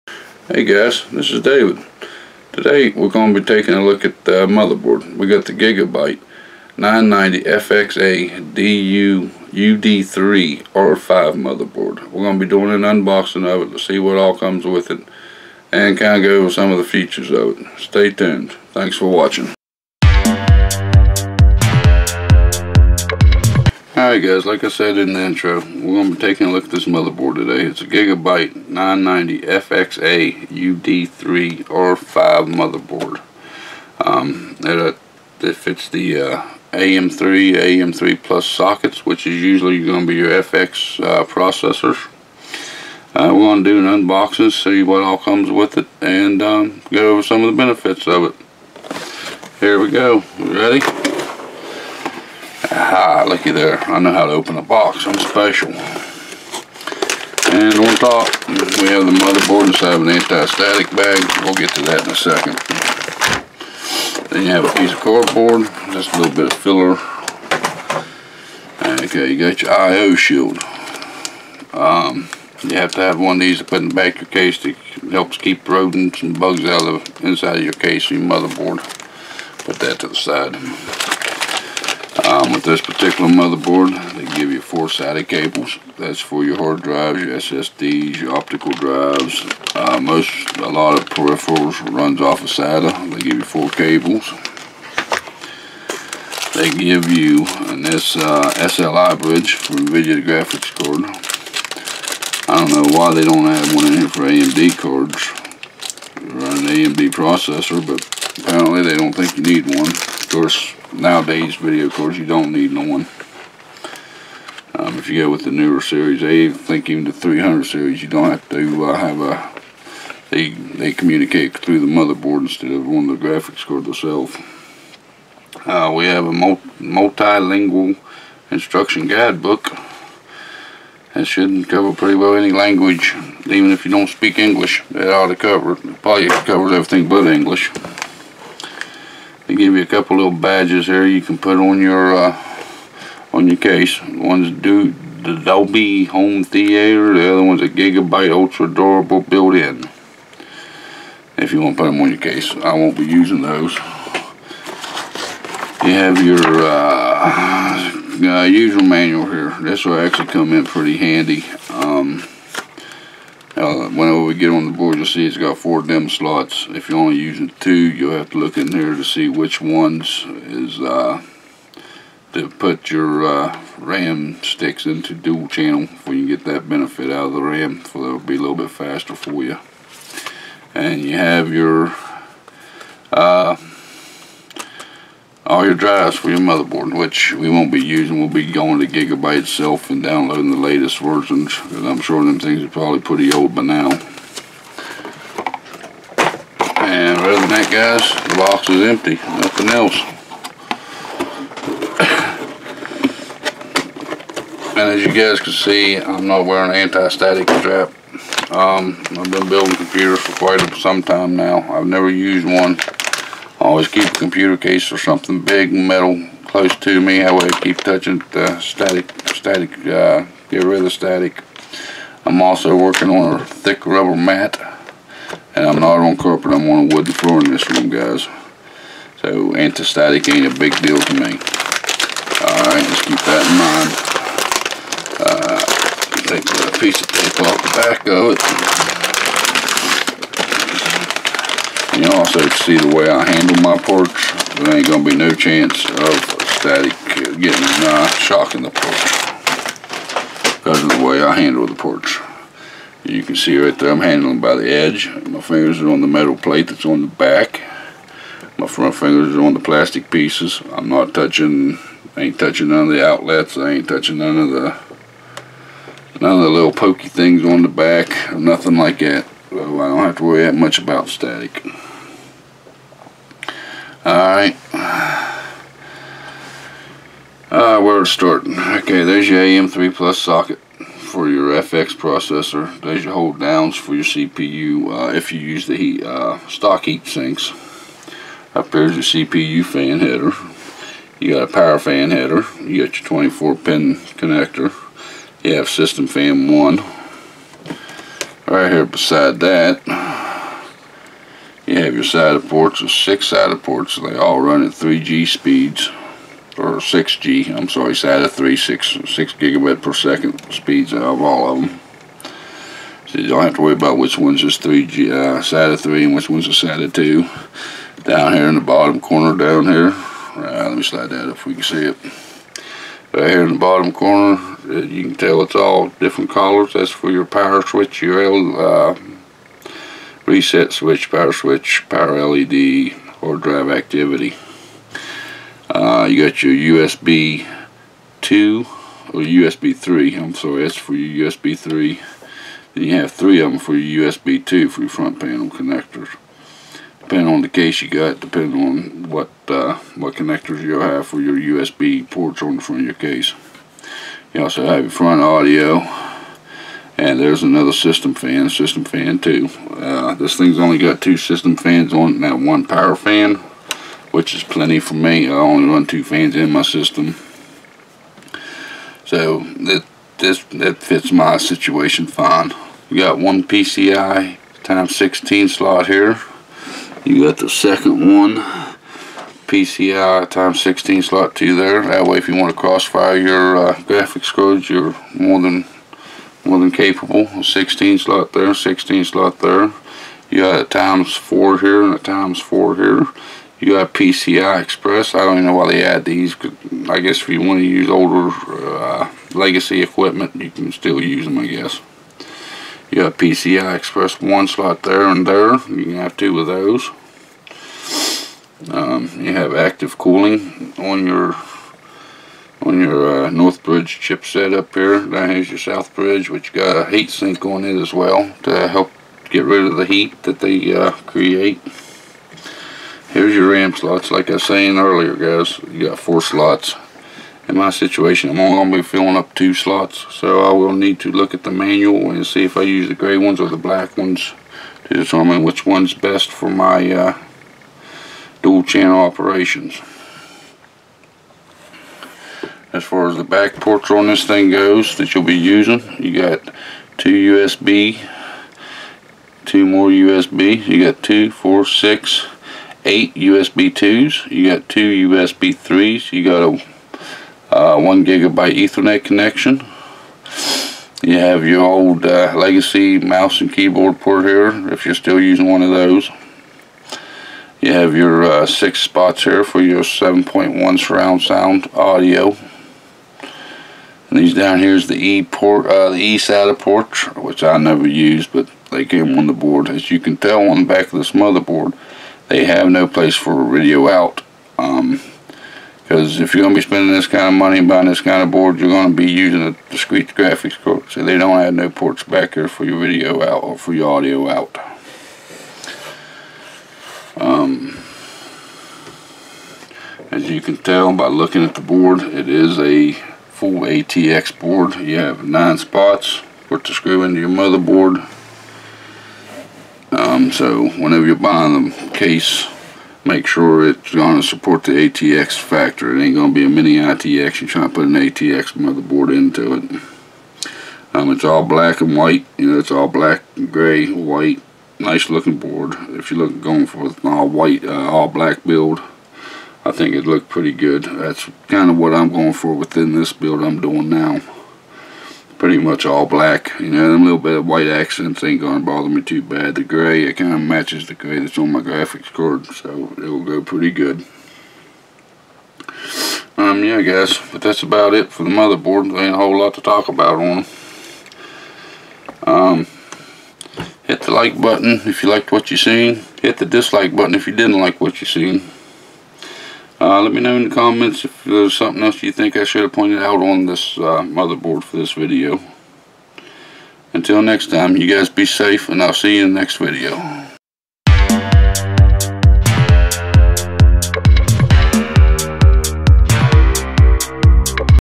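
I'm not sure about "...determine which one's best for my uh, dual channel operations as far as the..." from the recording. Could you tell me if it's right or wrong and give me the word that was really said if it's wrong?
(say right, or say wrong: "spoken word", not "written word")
right.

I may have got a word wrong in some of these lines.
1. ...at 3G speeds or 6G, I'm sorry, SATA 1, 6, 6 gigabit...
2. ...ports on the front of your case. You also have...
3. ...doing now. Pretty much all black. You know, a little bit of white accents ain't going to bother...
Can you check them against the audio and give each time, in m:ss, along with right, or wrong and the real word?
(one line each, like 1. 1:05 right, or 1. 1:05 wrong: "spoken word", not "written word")
1. 5:04 wrong: "3", not "1"
2. 5:52 right
3. 8:53 right.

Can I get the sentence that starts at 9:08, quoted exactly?
There ain't a whole lot to talk about on them.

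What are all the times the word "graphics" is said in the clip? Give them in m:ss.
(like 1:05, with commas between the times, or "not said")
1:40, 2:03, 6:23, 8:10, 9:01.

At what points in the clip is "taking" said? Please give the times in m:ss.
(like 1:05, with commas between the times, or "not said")
0:03, 0:26.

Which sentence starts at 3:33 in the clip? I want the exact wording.
Always keep a computer case or something big metal close to me.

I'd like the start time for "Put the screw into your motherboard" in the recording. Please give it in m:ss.
8:26.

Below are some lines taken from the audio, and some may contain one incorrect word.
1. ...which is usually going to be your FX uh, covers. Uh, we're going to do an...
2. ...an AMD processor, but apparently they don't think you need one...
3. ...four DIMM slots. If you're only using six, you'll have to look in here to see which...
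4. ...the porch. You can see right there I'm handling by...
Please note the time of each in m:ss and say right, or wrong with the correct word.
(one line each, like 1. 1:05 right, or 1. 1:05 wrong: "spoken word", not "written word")
1. 0:39 wrong: "processors", not "covers"
2. 1:46 right
3. 2:45 wrong: "two", not "six"
4. 4:11 right.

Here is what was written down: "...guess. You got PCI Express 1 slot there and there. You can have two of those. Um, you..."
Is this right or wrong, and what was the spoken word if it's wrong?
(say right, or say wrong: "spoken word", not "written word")
right.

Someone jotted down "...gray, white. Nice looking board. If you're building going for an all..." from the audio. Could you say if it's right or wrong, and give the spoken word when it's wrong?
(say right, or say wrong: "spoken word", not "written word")
wrong: "looking", not "building".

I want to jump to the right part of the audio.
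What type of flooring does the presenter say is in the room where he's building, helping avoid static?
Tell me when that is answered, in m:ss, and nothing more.
3:46.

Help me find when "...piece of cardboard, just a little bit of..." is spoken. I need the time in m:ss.
1:04.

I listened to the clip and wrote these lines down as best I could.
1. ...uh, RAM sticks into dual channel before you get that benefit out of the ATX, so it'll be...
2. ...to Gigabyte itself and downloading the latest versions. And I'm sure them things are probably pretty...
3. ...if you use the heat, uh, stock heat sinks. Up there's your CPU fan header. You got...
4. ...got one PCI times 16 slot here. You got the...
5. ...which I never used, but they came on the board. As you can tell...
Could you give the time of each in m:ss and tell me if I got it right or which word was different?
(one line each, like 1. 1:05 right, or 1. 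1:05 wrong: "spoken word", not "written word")
1. 2:53 wrong: "RAM", not "ATX"
2. 3:08 right
3. 4:45 right
4. 6:12 right
5. 7:57 right.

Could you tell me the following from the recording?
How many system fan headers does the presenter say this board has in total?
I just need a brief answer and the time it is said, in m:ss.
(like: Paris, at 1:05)
2, at 6:00.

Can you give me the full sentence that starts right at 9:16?
Hit the dislike button if you didn't like what you seen.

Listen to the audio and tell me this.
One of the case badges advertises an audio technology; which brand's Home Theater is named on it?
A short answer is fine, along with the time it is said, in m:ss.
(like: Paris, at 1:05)
Dolby, at 2:25.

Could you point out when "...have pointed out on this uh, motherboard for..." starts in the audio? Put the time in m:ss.
9:22.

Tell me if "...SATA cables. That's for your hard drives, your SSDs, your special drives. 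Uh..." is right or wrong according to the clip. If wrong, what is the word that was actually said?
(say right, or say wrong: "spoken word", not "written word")
wrong: "optical", not "special".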